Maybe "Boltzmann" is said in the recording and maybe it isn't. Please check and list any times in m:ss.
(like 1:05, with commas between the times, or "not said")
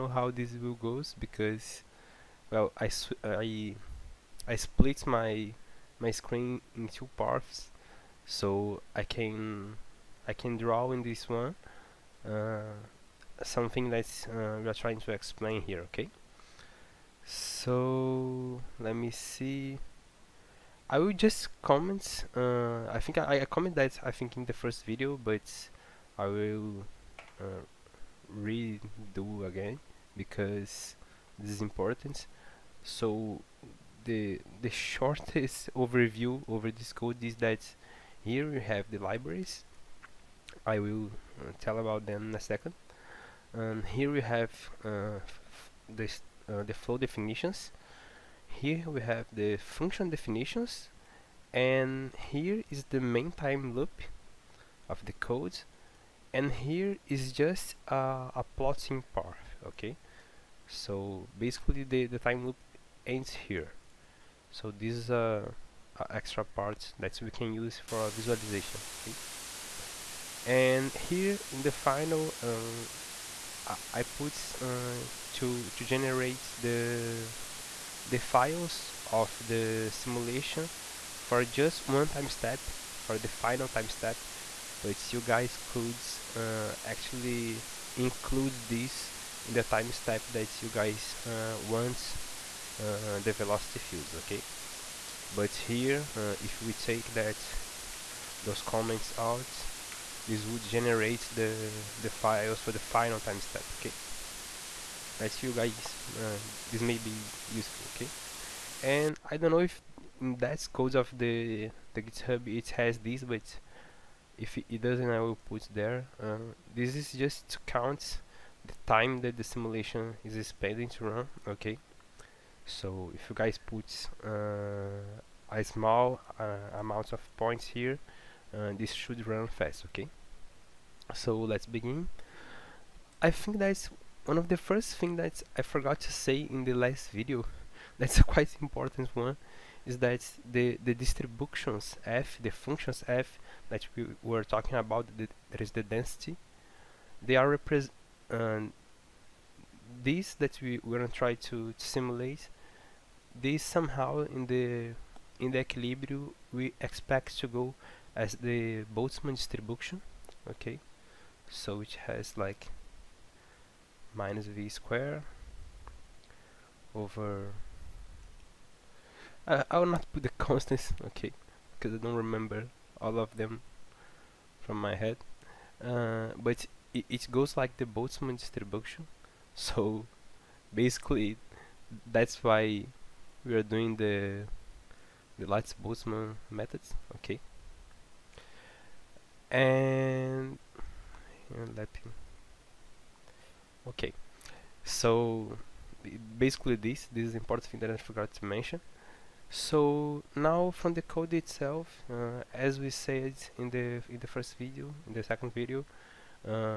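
2:38, 2:57, 3:05.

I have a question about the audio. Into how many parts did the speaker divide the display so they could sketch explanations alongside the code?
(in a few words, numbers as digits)
2.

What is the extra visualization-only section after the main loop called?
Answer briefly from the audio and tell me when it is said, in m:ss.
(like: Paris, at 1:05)
plotting part, at 0:58.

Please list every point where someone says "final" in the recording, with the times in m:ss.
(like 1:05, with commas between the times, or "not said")
1:11, 1:23, 1:42.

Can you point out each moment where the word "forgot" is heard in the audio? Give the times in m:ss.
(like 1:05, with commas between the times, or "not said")
2:15, 3:17.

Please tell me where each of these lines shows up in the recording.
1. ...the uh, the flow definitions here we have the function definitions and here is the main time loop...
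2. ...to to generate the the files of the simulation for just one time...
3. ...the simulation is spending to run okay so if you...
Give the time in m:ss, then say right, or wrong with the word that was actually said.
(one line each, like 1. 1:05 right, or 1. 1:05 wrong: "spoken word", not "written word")
1. 0:45 right
2. 1:15 right
3. 1:59 right.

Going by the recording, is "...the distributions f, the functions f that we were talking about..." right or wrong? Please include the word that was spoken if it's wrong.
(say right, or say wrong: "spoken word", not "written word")
right.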